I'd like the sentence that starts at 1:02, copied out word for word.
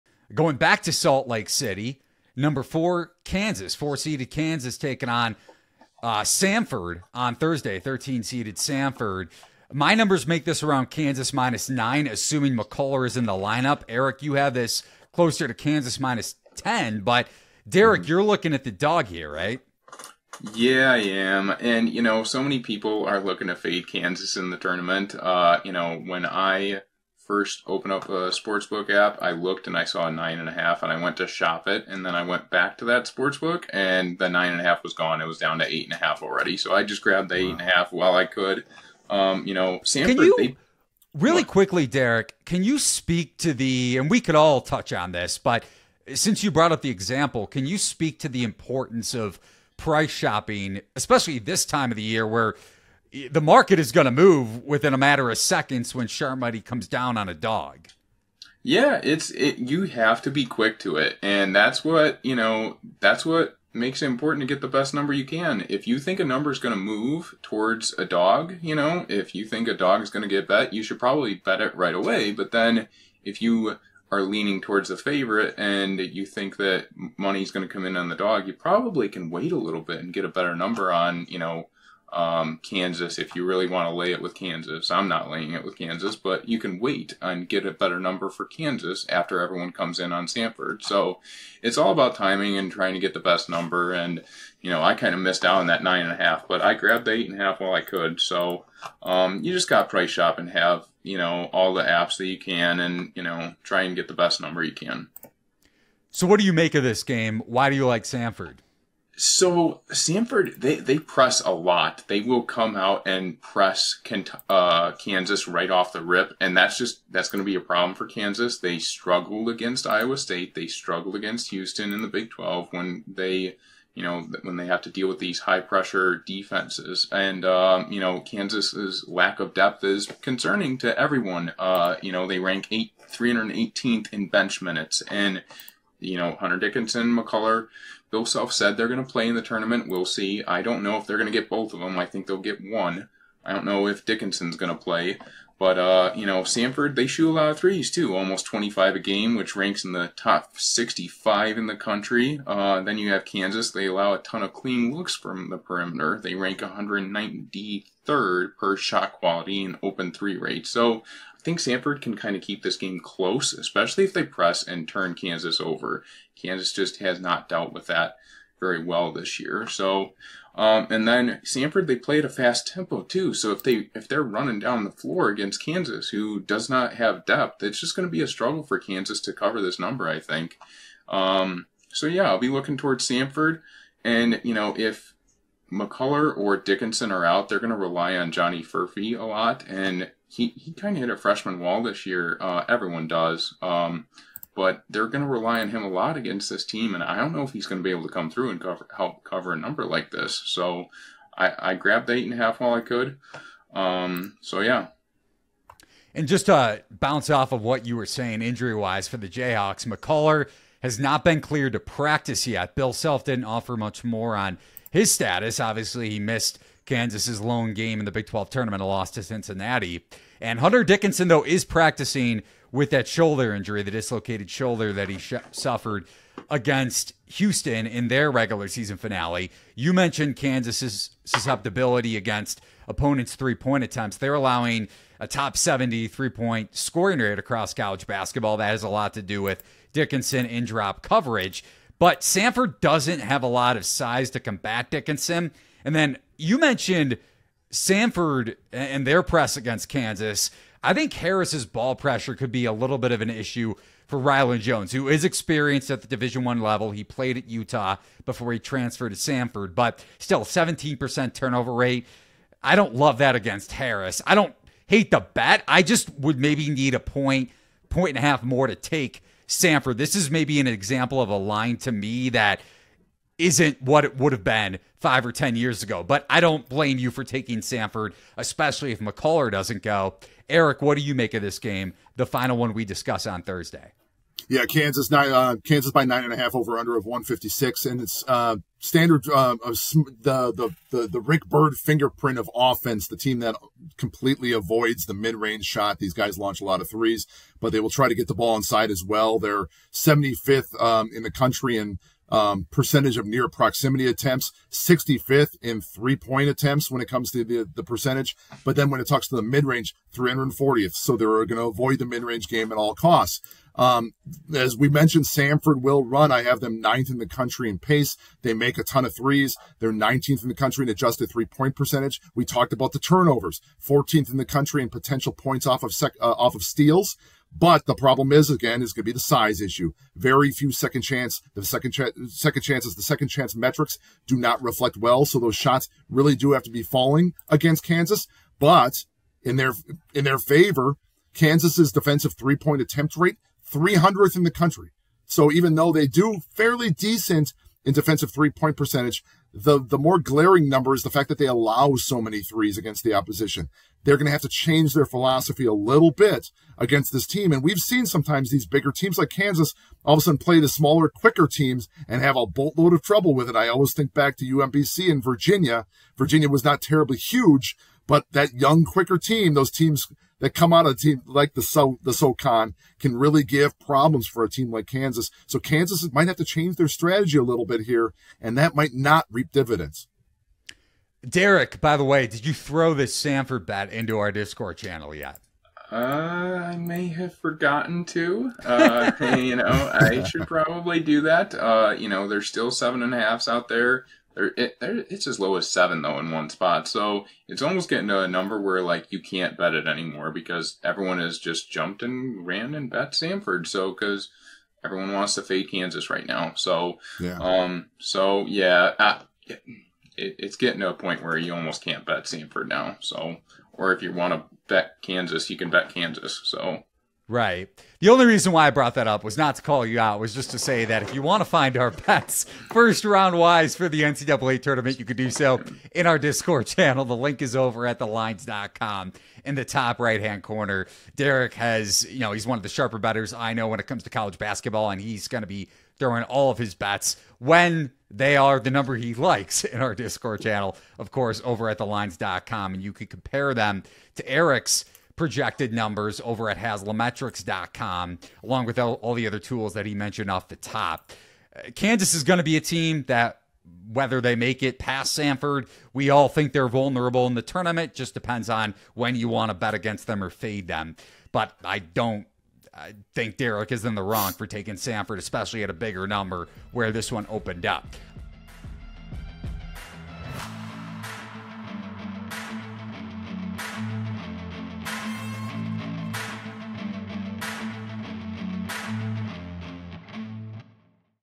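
That's what makes it important to get the best number you can.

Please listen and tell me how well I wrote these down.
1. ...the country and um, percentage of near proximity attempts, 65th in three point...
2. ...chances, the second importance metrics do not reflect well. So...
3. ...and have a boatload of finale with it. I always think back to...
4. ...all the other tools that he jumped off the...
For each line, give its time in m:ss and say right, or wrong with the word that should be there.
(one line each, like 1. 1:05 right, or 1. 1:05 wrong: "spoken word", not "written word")
1. 5:01 right
2. 5:32 wrong: "chance", not "importance"
3. 6:02 wrong: "trouble", not "finale"
4. 7:29 wrong: "mentioned", not "jumped".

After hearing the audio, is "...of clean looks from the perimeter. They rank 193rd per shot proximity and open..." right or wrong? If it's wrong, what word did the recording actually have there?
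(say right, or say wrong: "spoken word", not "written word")
wrong: "quality", not "proximity".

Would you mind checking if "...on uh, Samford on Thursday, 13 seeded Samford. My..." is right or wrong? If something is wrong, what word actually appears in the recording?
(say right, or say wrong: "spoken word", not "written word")
right.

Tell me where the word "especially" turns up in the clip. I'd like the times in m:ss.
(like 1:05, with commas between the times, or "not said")
0:50, 2:43, 4:38, 7:45.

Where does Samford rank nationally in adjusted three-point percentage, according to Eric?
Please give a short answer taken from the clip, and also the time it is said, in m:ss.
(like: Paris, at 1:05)
19th, at 5:19.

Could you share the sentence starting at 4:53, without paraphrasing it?
The team that completely avoids the mid range shot.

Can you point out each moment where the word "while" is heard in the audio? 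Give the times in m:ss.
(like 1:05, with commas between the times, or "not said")
0:37, 1:37, 3:22.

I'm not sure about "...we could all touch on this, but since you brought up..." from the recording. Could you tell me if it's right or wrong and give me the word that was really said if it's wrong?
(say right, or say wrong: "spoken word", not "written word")
right.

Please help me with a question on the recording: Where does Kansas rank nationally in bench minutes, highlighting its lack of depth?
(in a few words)
318th.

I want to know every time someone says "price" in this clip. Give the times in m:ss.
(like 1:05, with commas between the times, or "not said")
0:49, 1:39.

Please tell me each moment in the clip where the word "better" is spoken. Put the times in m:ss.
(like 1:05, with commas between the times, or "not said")
1:20, 1:27, 7:12.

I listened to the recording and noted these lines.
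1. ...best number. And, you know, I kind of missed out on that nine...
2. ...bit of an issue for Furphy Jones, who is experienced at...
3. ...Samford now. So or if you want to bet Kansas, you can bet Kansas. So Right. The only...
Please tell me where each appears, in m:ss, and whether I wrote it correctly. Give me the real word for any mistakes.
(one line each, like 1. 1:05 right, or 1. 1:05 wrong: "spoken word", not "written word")
1. 1:33 right
2. 4:12 wrong: "Rylan", not "Furphy"
3. 6:52 right.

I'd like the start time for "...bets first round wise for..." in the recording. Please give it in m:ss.
7:01.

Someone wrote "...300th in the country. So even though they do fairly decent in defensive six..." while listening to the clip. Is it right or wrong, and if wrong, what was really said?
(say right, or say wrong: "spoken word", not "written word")
wrong: "three", not "six".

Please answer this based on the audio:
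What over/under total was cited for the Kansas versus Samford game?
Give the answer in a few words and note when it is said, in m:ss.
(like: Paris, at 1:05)
156, at 4:47.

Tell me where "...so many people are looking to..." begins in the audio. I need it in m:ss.
0:22.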